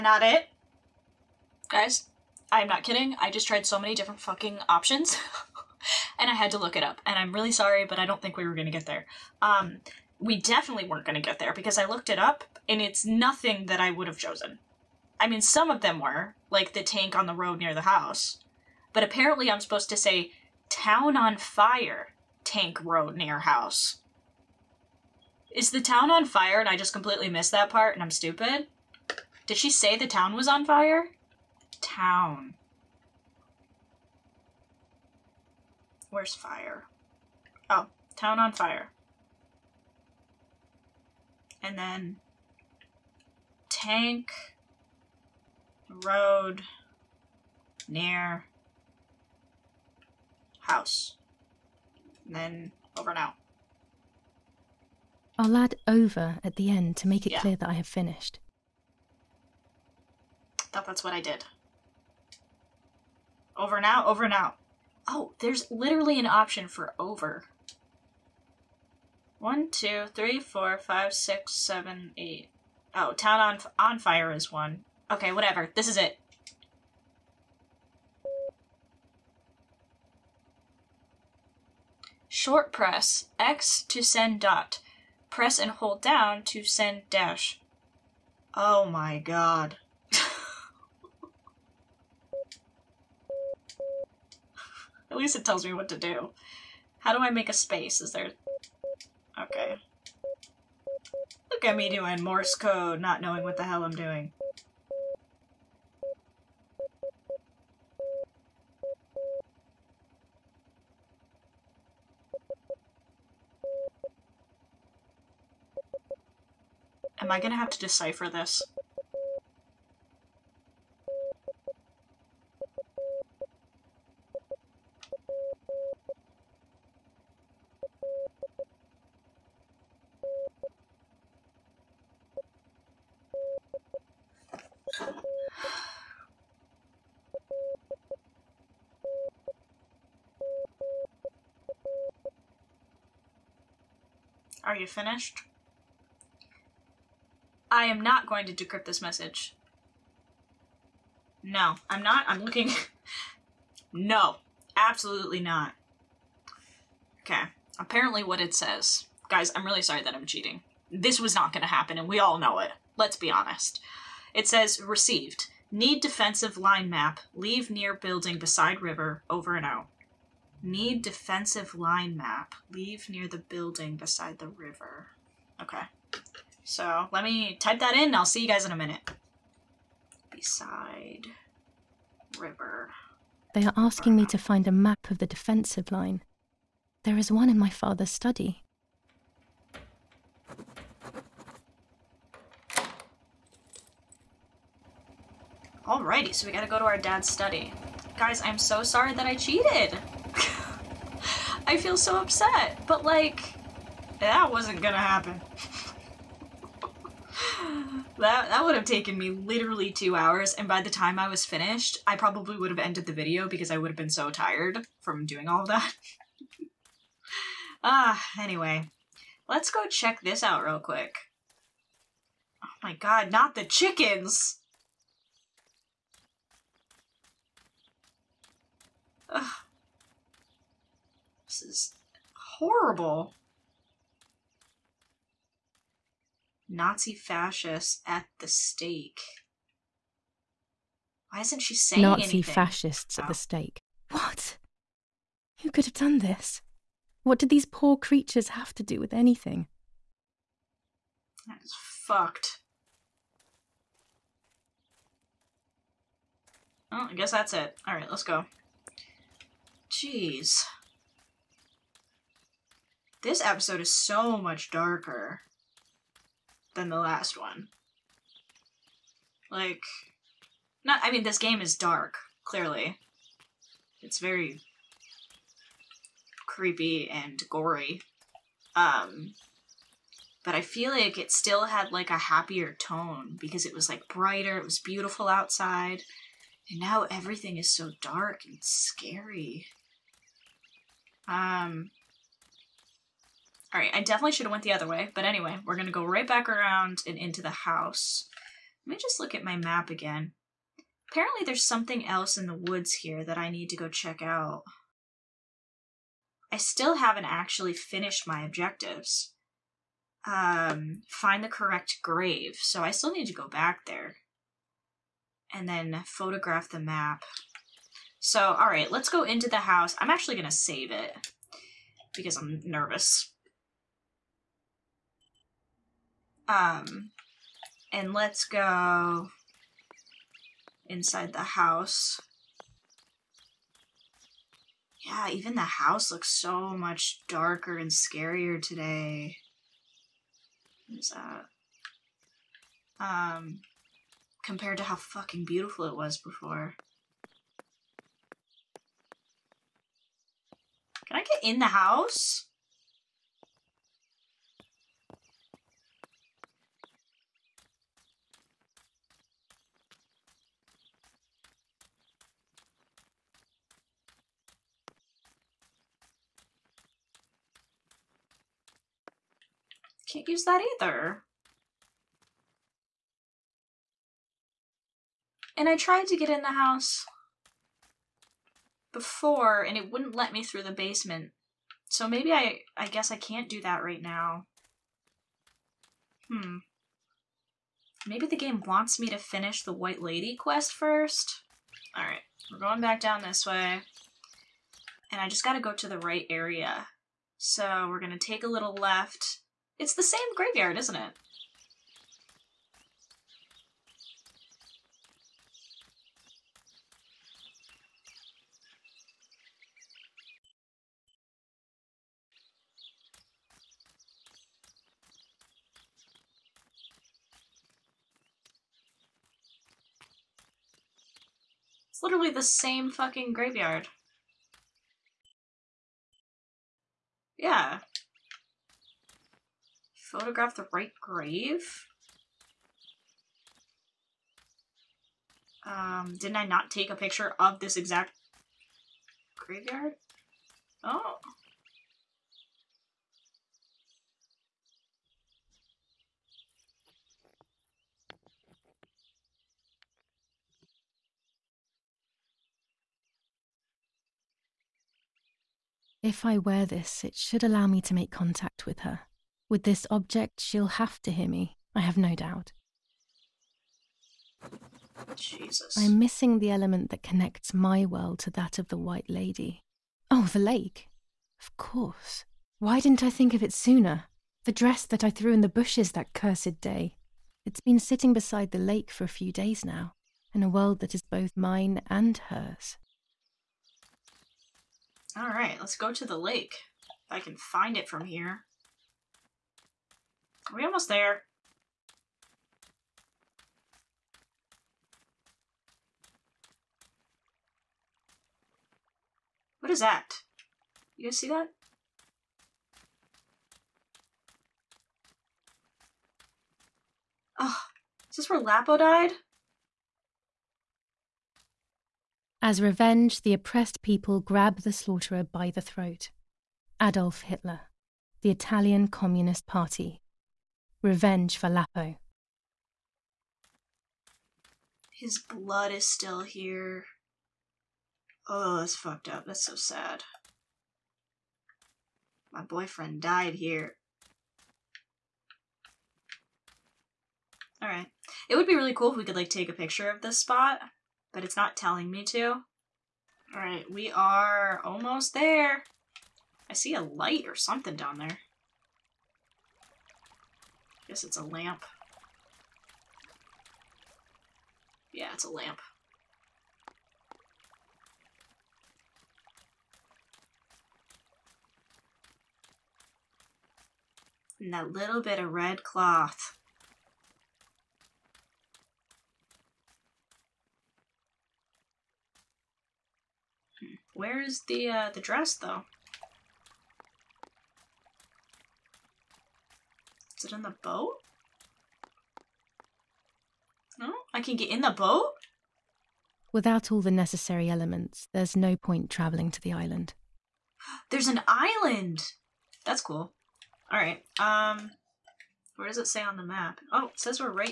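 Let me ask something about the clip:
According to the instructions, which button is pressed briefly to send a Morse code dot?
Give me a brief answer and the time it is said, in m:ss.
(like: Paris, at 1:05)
X, at 1:23.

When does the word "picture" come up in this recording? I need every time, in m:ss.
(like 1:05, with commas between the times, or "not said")
7:16, 8:59.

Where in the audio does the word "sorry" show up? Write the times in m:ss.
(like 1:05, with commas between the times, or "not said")
0:07, 2:39, 3:18.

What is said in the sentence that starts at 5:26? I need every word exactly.
Um, and let's go inside the house.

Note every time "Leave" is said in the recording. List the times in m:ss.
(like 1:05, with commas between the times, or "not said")
2:47, 2:52.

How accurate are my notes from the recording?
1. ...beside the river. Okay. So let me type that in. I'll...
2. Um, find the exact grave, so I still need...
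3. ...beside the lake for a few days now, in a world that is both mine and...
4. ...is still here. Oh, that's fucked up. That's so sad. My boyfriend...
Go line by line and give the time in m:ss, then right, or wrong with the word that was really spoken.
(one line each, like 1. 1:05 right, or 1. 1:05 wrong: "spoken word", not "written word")
1. 2:53 right
2. 5:10 wrong: "correct", not "exact"
3. 7:58 right
4. 8:45 right.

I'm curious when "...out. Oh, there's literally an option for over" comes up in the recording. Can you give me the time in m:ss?
1:04.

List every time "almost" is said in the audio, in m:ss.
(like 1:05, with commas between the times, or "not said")
8:10, 9:04.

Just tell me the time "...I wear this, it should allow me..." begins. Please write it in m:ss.
7:36.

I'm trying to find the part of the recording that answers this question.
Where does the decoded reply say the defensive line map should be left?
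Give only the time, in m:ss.
2:47.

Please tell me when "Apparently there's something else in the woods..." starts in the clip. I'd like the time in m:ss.
5:01.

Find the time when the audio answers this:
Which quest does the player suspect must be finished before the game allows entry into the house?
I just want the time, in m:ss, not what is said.
6:29.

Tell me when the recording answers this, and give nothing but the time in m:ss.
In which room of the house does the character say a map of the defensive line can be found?
3:07.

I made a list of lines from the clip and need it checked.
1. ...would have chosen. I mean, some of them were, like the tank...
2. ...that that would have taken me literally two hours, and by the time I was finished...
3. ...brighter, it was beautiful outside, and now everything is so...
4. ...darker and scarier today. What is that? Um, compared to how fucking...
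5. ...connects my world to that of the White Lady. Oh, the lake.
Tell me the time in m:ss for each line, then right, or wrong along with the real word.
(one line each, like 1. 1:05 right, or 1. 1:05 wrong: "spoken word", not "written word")
1. 0:13 right
2. 3:28 right
3. 4:44 right
4. 5:37 right
5. 7:47 right.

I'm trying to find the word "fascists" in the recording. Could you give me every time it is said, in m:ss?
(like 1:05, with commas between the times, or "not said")
3:57, 4:02.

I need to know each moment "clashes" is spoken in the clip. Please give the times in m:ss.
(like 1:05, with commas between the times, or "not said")
not said.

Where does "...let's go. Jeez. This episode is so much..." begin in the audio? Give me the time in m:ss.
4:18.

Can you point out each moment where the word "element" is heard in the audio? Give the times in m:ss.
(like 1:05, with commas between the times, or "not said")
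7:46, 9:47.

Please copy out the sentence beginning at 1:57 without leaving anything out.
Am I gonna have to decipher this?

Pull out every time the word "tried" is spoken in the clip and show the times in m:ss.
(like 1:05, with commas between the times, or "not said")
0:03, 6:15.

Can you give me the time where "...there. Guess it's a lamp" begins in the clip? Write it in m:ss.
9:07.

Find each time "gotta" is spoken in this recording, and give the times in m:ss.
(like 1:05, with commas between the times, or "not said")
3:16, 6:35.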